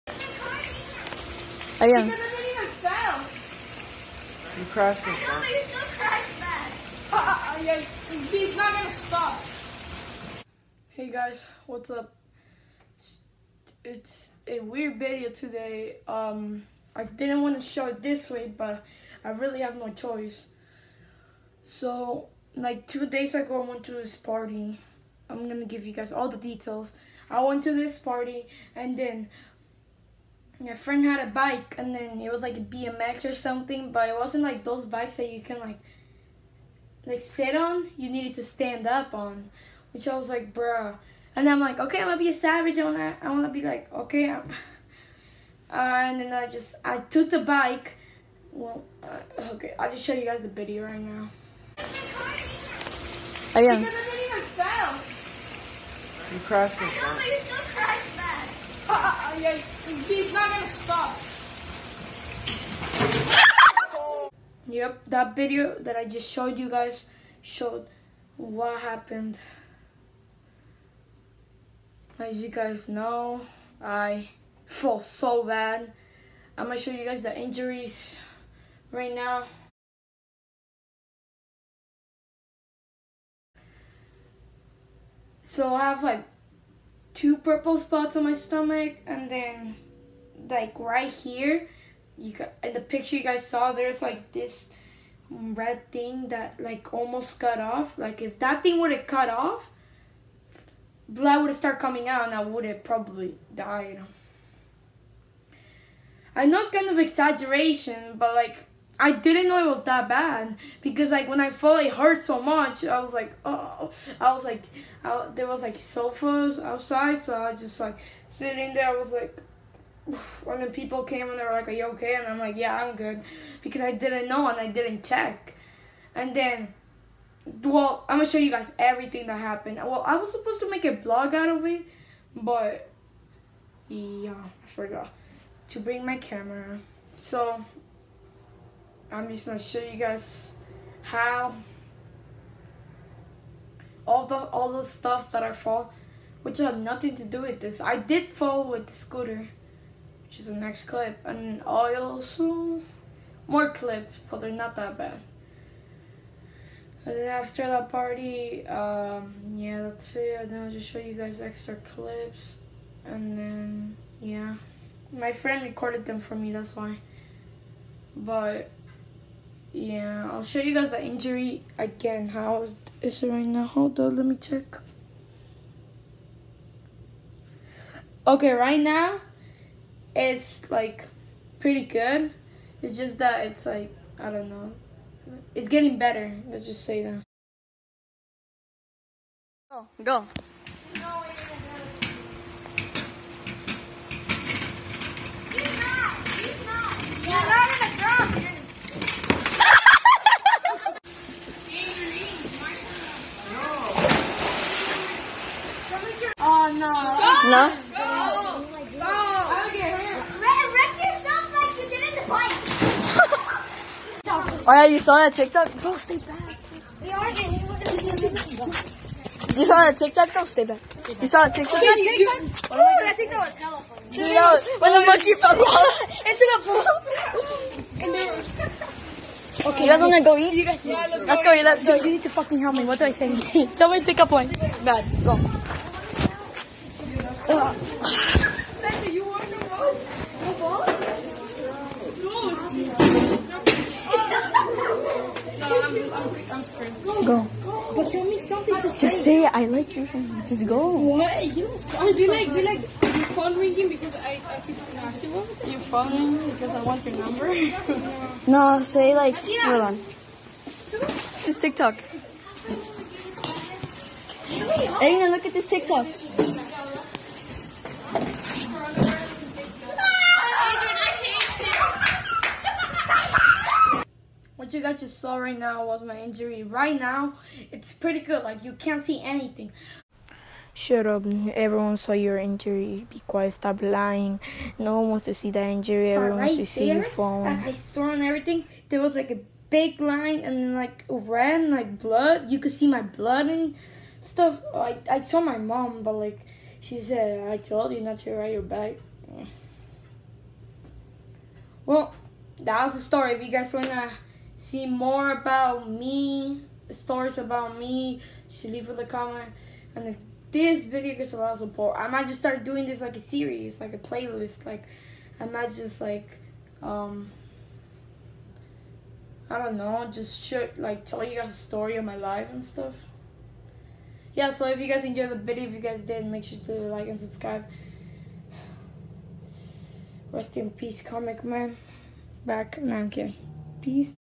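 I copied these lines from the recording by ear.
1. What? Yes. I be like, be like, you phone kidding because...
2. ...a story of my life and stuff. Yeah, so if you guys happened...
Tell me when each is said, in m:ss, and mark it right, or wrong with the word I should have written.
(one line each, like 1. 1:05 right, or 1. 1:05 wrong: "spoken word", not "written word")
1. 4:10 wrong: "ringing", not "kidding"
2. 5:21 wrong: "enjoyed", not "happened".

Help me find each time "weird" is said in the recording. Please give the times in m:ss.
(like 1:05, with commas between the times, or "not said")
0:14.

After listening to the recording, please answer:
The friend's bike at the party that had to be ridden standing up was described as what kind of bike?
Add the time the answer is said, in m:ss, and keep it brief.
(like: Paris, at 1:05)
BMX, at 0:32.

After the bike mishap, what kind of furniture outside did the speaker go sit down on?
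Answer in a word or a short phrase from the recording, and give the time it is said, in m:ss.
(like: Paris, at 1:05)
Sofas, at 1:55.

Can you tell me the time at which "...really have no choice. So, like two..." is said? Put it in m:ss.
0:19.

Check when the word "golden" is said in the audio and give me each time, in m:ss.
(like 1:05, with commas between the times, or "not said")
not said.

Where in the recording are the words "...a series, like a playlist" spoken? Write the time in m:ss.
5:13.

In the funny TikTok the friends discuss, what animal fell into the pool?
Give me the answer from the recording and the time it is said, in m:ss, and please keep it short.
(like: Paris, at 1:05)
Monkey, at 3:45.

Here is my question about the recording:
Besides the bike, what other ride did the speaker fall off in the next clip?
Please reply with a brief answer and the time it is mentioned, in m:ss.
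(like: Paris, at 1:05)
Scooter, at 2:28.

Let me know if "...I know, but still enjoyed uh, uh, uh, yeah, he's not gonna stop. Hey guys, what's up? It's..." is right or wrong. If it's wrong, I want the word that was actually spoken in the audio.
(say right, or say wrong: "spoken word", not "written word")
wrong: "crashed", not "enjoyed".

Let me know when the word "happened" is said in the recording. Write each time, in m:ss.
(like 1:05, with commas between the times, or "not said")
1:08, 2:09.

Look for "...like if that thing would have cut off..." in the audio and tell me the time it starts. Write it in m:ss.
1:37.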